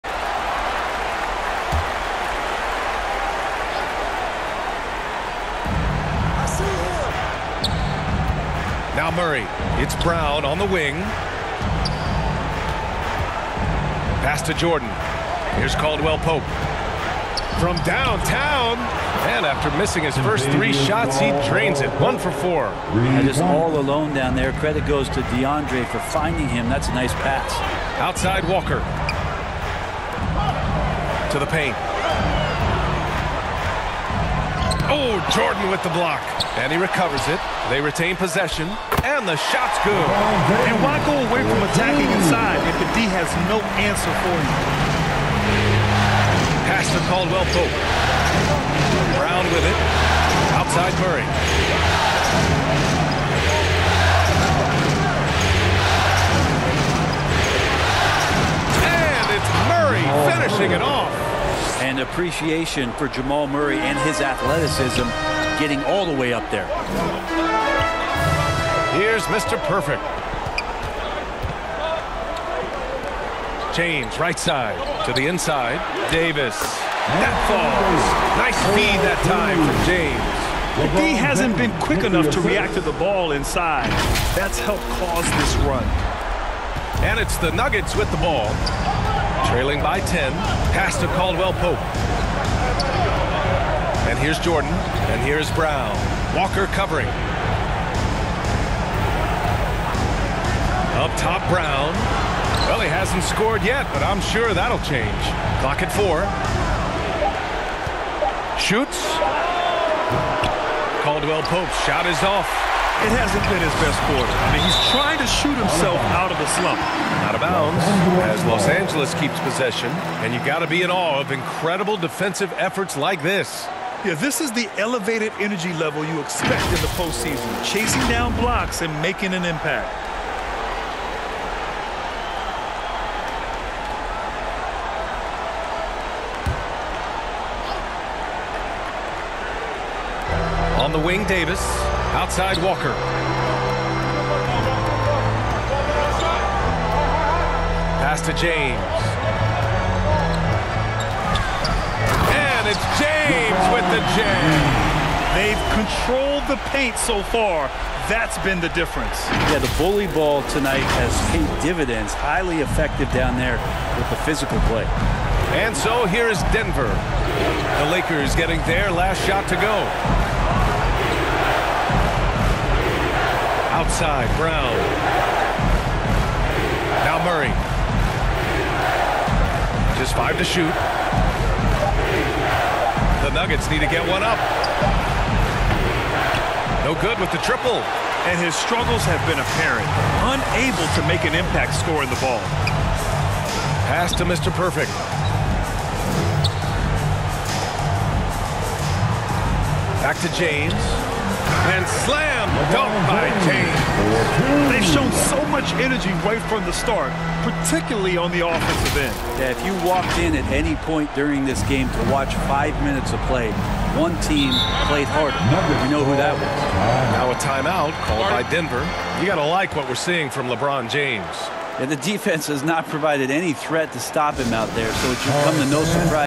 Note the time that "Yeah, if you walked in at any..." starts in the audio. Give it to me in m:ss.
3:29.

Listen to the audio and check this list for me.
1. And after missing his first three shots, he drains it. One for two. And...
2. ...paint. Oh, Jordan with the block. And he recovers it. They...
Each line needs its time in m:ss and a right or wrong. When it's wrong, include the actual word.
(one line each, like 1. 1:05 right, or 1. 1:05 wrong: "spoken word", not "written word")
1. 0:19 wrong: "four", not "two"
2. 0:31 right.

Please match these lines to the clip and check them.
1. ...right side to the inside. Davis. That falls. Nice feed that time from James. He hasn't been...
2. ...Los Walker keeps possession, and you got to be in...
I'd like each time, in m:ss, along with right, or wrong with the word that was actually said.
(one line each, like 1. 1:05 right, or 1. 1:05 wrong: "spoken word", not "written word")
1. 1:14 right
2. 1:58 wrong: "Angeles", not "Walker".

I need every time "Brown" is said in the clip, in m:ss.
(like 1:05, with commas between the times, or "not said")
0:10, 0:49, 1:35, 1:41, 2:54.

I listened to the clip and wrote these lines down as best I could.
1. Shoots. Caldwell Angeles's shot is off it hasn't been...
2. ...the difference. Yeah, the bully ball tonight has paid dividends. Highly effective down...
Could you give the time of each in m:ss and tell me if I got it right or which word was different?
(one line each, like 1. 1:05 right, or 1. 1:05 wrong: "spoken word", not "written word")
1. 1:48 wrong: "Pope", not "Angeles"
2. 2:38 right.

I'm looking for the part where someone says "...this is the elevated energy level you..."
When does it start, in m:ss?
2:04.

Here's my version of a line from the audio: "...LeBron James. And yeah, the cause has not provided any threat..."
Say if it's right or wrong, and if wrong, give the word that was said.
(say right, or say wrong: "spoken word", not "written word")
wrong: "defense", not "cause".